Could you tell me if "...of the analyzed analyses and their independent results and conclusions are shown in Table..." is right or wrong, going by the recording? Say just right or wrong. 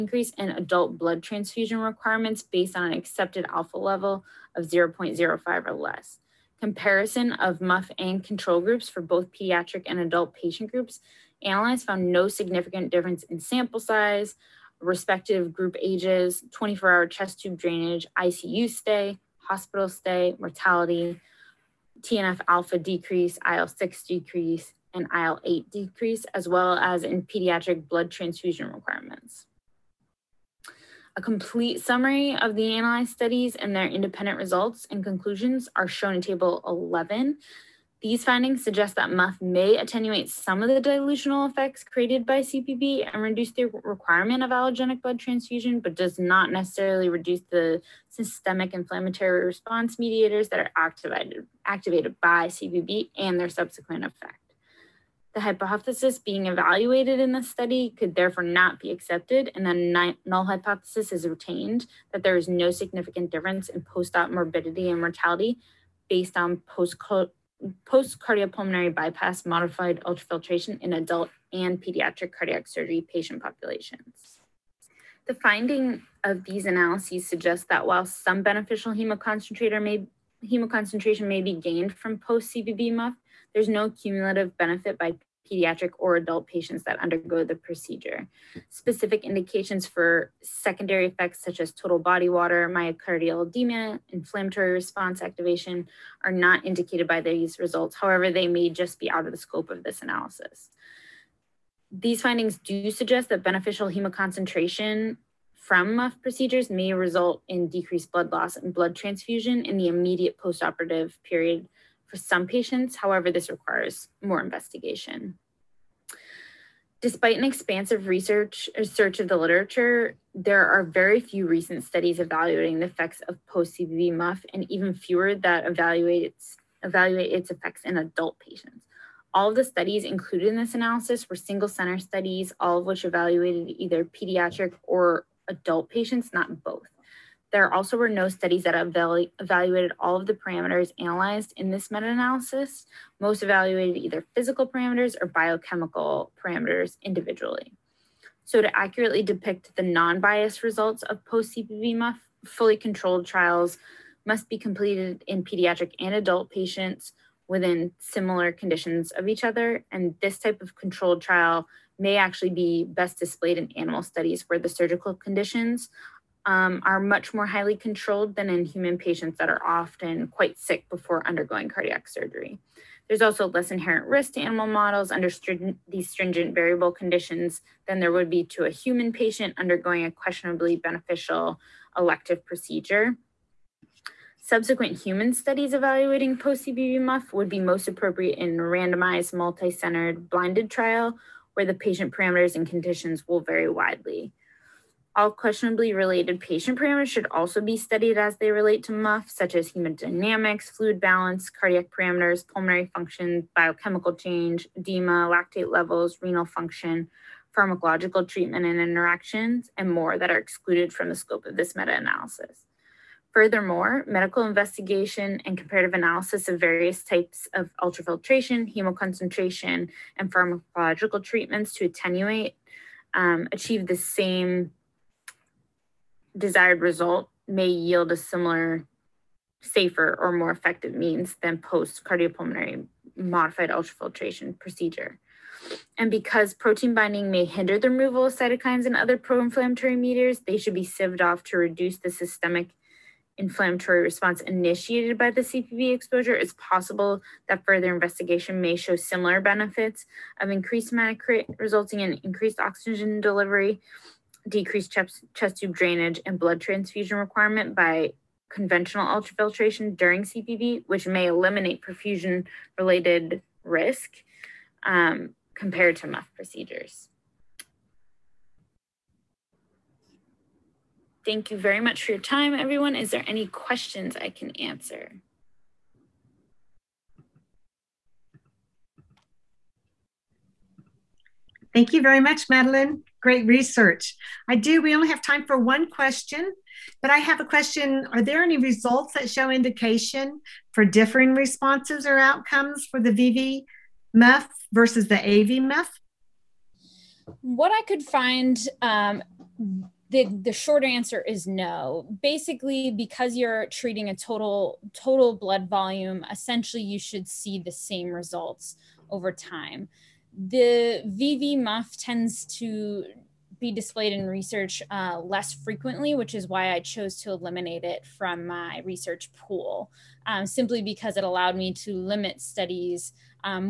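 wrong.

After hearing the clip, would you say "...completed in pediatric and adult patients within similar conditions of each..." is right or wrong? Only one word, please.
right.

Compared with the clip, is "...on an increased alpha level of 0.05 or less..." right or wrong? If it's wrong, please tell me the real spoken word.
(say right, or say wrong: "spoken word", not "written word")
wrong: "accepted", not "increased".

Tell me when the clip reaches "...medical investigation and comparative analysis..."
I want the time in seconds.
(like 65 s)
214 s.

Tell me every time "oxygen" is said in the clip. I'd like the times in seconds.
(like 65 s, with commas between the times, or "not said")
252 s.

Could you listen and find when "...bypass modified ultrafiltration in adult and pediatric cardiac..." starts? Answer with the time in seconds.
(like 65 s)
68 s.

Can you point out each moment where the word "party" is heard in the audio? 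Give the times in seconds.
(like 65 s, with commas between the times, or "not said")
not said.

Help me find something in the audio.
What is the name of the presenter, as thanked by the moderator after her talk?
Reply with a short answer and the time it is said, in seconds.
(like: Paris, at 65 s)
Madeleine, at 282 s.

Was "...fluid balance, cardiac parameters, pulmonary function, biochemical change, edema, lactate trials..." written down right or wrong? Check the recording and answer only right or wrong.
wrong.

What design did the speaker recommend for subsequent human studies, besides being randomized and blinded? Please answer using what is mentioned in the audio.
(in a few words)
multi-centered.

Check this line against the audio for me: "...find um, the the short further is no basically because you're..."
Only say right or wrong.
wrong.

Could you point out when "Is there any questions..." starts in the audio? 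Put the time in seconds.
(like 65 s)
272 s.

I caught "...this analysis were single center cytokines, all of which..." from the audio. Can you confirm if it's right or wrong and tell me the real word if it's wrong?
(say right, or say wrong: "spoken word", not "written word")
wrong: "studies", not "cytokines".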